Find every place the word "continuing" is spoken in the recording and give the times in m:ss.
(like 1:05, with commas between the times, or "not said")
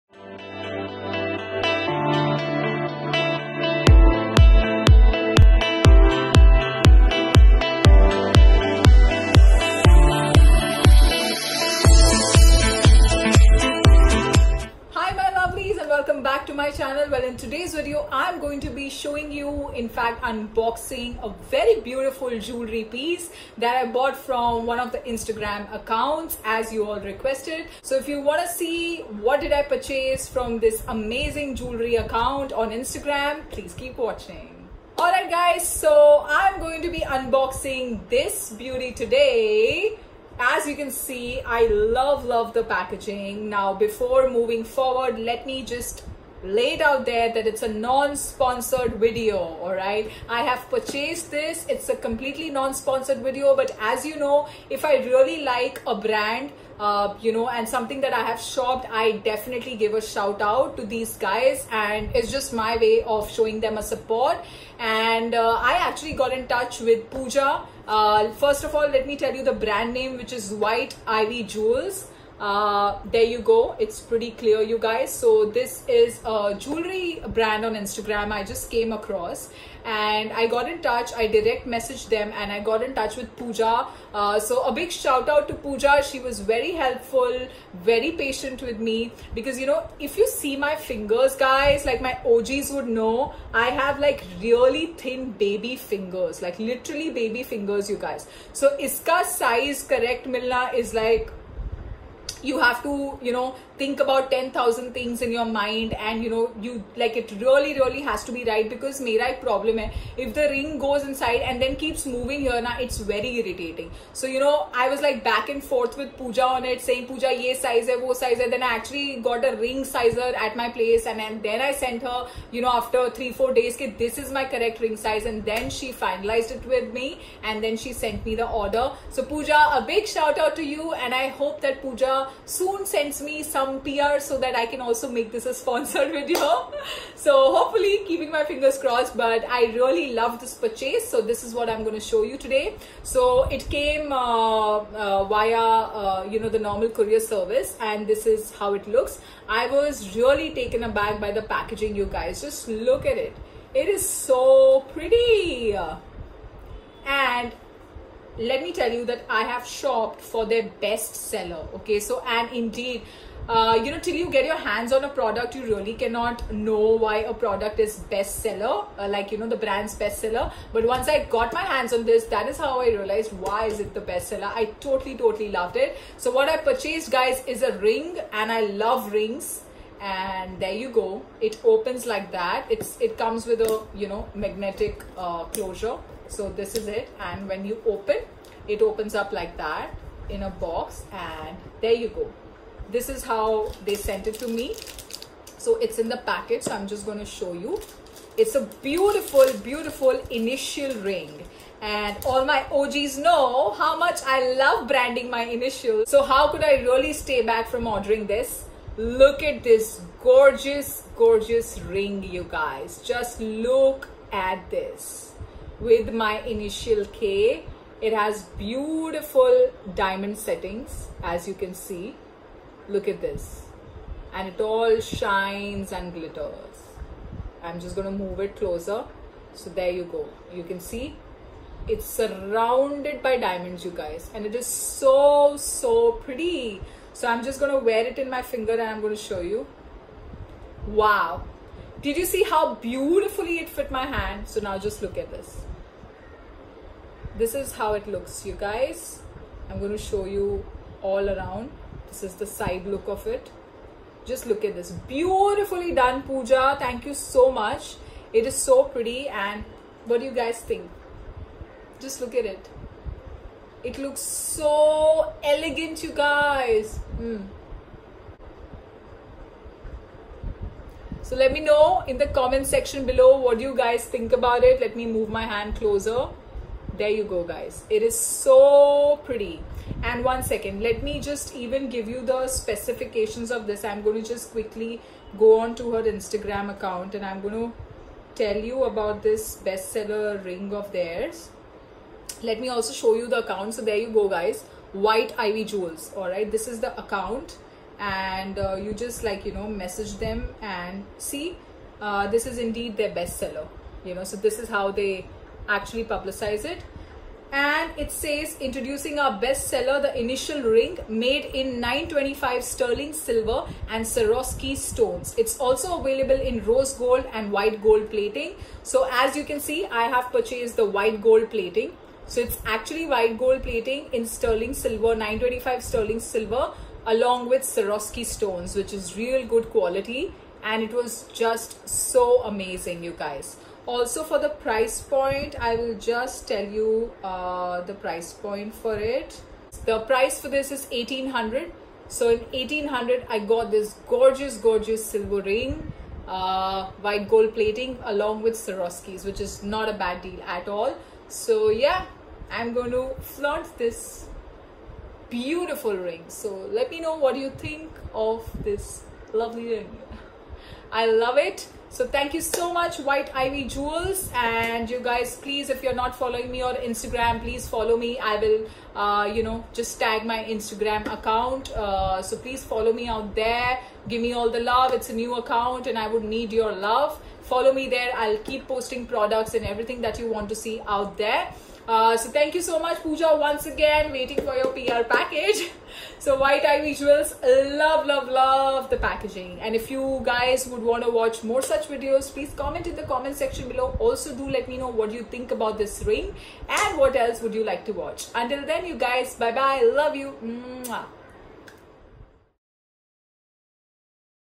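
not said.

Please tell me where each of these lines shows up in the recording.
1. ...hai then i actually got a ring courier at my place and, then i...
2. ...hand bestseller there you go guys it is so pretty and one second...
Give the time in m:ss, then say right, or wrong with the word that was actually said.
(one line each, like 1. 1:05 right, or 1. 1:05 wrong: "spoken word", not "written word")
1. 1:58 wrong: "sizer", not "courier"
2. 4:35 wrong: "closer", not "bestseller".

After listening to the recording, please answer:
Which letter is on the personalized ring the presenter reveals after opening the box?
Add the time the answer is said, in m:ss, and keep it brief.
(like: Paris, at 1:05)
K, at 3:37.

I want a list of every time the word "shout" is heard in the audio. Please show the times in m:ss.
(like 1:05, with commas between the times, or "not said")
1:00, 1:24, 2:10.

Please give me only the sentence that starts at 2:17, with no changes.
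so hopefully keeping my fingers crossed but I really love this purchase.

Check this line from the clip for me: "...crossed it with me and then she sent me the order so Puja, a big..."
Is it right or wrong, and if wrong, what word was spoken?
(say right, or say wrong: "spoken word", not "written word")
wrong: "finalized", not "crossed".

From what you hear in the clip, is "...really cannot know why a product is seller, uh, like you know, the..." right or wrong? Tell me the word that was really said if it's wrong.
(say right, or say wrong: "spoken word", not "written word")
wrong: "bestseller", not "seller".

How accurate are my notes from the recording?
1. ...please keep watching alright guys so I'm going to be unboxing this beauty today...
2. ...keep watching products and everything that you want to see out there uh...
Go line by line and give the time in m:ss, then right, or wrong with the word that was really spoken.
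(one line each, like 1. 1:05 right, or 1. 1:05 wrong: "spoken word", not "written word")
1. 0:33 right
2. 6:18 wrong: "posting", not "watching".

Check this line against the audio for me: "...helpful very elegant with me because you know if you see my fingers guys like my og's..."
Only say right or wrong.
wrong.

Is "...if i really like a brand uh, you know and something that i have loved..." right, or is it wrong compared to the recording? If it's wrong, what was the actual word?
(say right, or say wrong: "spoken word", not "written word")
wrong: "shopped", not "loved".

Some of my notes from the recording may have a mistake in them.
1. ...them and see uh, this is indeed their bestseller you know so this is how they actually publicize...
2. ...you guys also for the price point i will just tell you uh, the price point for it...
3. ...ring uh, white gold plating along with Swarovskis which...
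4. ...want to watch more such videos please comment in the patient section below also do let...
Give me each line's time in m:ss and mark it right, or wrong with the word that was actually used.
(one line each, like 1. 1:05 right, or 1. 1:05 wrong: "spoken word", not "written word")
1. 5:00 right
2. 5:33 right
3. 5:45 right
4. 6:30 wrong: "comment", not "patient".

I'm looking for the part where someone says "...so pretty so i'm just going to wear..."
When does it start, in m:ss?
3:55.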